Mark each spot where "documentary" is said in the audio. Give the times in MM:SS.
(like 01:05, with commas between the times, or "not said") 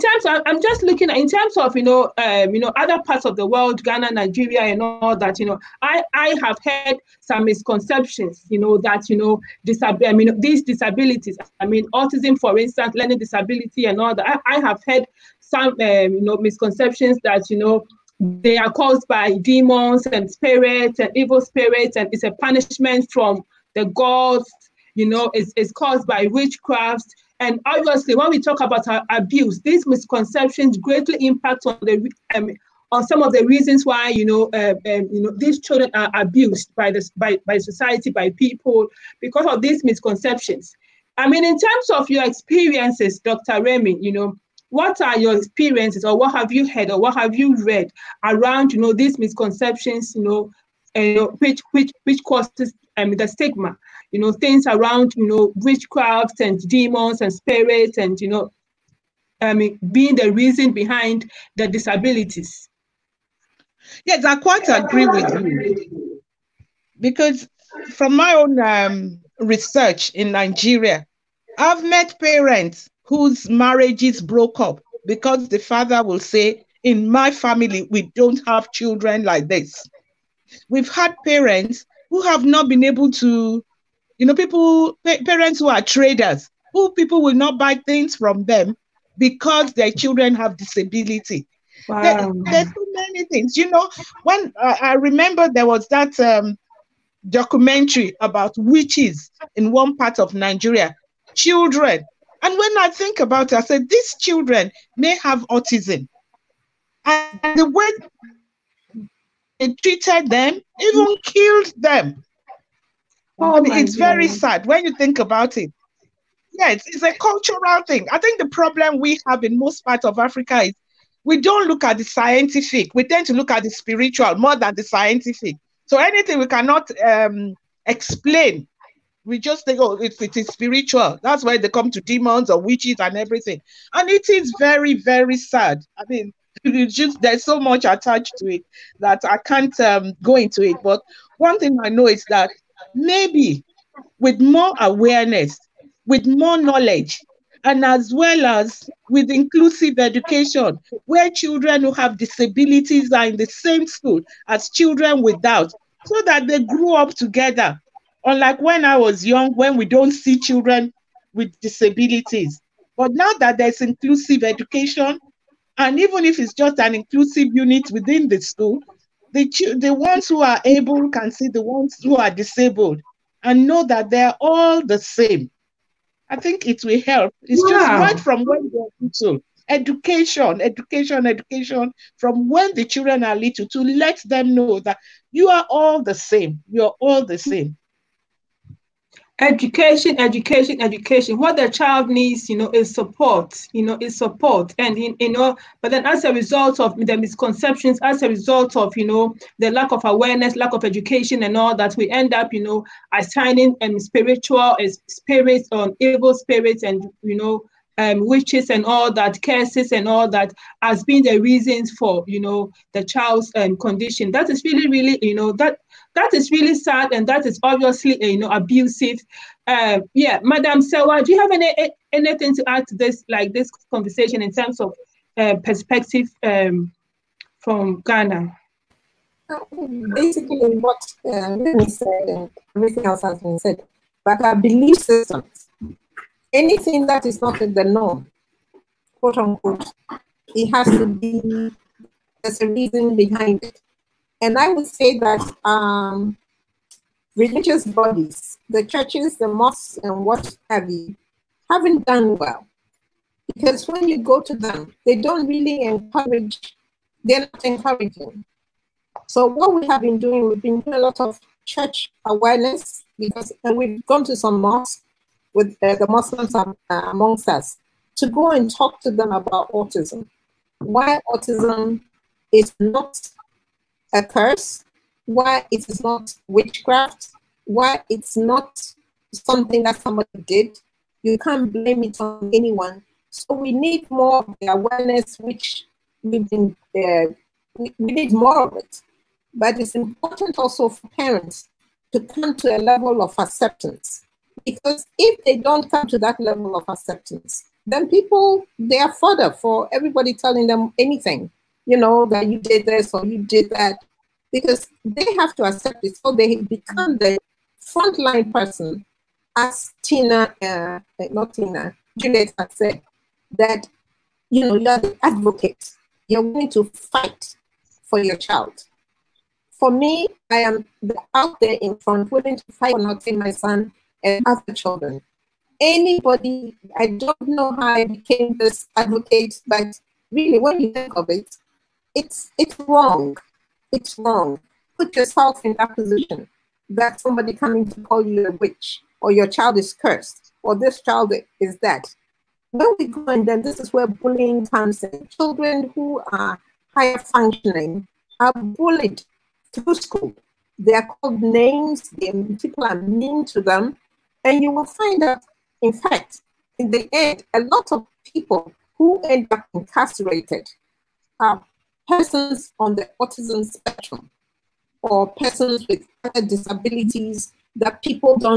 01:37.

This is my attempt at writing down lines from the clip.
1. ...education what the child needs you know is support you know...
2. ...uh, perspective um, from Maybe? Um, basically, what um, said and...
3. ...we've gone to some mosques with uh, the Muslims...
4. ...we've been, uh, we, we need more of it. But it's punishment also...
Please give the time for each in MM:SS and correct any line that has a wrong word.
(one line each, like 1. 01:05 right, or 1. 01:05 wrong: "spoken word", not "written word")
1. 03:10 right
2. 03:45 wrong: "Ghana", not "Maybe"
3. 04:23 right
4. 04:46 wrong: "important", not "punishment".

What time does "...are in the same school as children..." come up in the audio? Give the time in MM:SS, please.
02:33.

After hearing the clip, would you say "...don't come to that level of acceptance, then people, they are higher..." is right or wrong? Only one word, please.
wrong.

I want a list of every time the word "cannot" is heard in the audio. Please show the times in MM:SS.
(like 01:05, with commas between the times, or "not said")
02:06.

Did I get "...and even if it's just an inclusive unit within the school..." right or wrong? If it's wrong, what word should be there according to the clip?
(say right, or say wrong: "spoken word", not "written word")
right.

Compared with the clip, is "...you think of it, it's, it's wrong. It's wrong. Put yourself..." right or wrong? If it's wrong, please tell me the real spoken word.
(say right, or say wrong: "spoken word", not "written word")
right.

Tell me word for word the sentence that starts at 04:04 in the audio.
And I would say that um, religious bodies, the churches, the mosques, and what have you, haven't done well.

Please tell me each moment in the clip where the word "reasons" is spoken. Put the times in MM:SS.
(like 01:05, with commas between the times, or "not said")
00:33, 01:00, 03:31, 04:02.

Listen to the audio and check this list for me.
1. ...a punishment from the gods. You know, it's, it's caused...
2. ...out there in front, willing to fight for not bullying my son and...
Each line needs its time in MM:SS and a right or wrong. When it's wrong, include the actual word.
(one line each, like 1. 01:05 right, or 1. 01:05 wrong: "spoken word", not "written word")
1. 00:22 right
2. 05:21 wrong: "seeing", not "bullying".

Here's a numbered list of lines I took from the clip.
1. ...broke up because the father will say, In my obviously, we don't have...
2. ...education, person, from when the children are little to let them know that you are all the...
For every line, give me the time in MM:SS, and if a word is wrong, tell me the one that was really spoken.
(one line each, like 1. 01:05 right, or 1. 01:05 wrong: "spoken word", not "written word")
1. 01:14 wrong: "family", not "obviously"
2. 03:00 wrong: "education", not "person".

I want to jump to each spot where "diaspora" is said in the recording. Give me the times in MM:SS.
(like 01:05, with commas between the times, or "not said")
not said.